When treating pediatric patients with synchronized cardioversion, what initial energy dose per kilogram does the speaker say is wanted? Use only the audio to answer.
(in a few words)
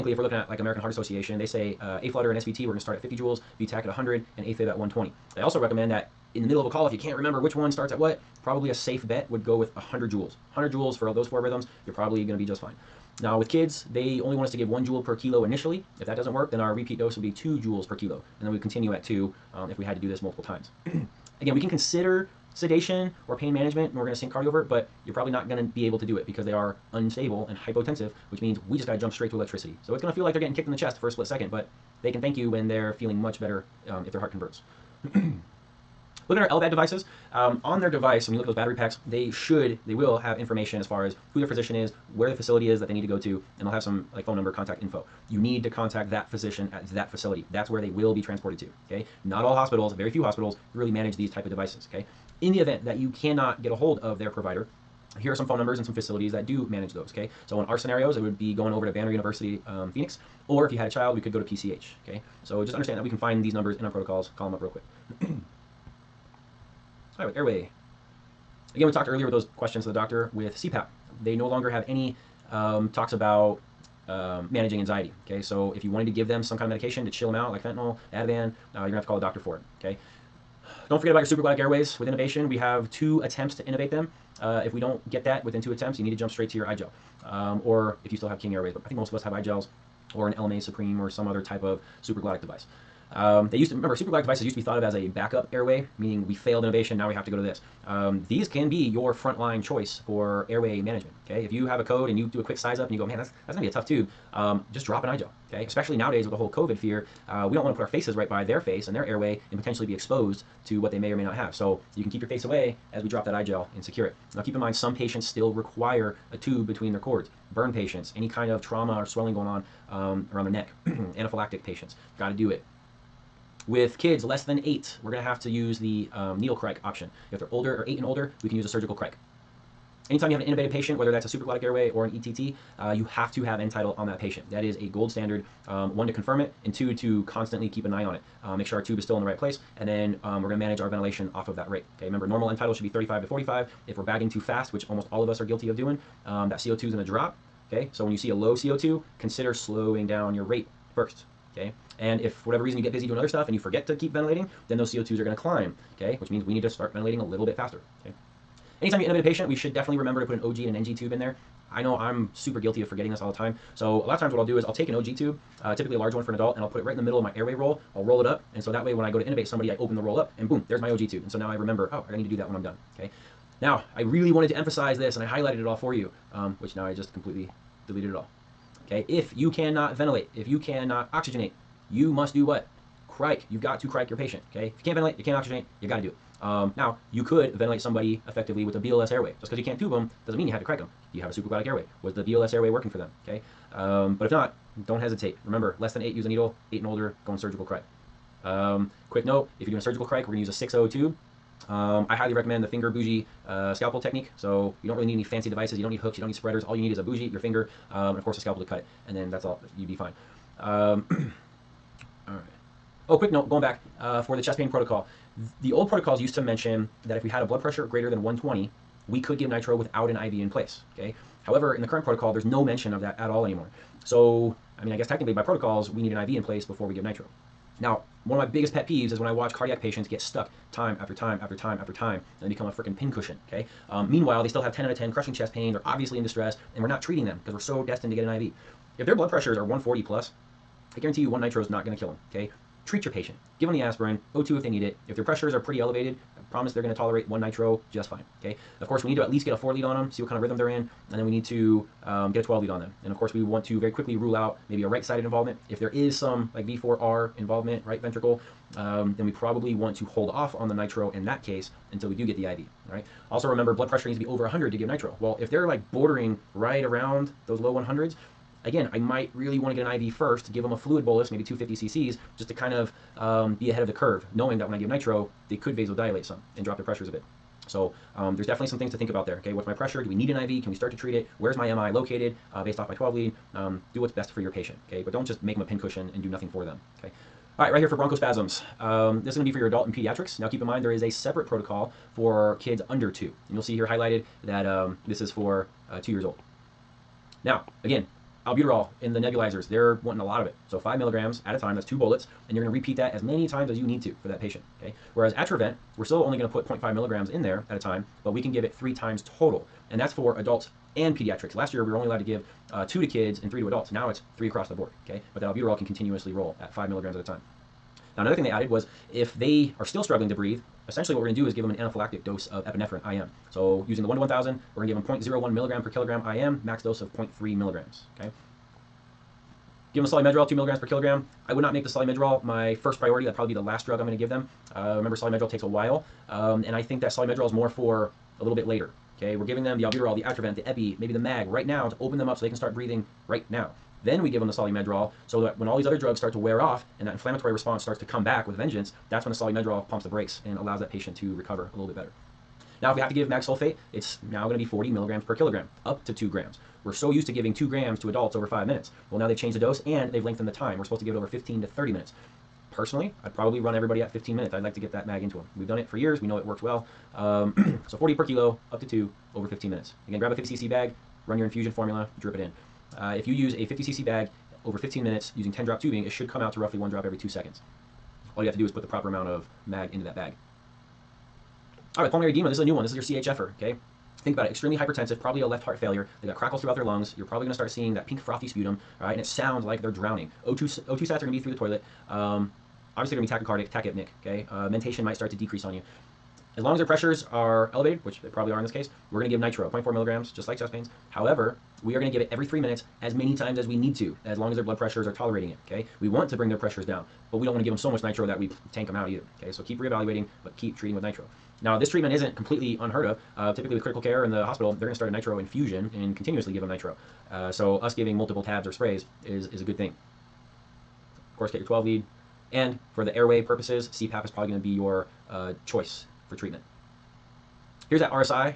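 1 joule per kilo.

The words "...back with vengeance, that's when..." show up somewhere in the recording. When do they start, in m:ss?
5:48.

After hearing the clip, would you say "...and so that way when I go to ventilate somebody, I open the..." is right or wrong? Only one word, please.
wrong.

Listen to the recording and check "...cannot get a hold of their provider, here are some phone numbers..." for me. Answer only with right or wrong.
right.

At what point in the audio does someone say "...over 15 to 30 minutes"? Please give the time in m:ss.
6:01.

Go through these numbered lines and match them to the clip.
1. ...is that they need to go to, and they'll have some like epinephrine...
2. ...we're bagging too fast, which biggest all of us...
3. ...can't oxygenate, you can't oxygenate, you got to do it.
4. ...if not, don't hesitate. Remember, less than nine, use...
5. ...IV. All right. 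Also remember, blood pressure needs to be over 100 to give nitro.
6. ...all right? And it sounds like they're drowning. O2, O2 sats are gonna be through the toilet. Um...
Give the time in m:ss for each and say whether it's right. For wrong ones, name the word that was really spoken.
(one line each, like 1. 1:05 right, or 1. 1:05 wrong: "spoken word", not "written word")
1. 0:42 wrong: "phone", not "epinephrine"
2. 2:23 wrong: "almost", not "biggest"
3. 3:04 wrong: "ventilate", not "oxygenate"
4. 3:14 wrong: "eight", not "nine"
5. 4:22 right
6. 6:29 right.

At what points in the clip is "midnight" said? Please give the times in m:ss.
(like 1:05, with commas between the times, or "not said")
not said.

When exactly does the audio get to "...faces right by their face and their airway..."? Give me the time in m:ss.
1:47.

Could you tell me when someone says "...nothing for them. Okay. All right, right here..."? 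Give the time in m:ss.
4:46.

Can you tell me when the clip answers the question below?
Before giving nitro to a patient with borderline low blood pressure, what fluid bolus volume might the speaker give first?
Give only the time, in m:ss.
4:31.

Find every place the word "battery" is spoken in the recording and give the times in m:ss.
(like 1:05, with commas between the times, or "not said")
0:38.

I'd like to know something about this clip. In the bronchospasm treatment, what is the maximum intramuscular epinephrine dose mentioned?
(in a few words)
0.3 milligrams.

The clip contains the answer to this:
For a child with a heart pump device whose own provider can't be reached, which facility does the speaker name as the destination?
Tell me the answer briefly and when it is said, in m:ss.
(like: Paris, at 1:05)
PCH, at 1:01.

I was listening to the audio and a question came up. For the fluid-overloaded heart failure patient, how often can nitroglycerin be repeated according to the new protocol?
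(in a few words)
every 3 minutes.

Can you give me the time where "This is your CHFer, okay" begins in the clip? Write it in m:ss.
6:22.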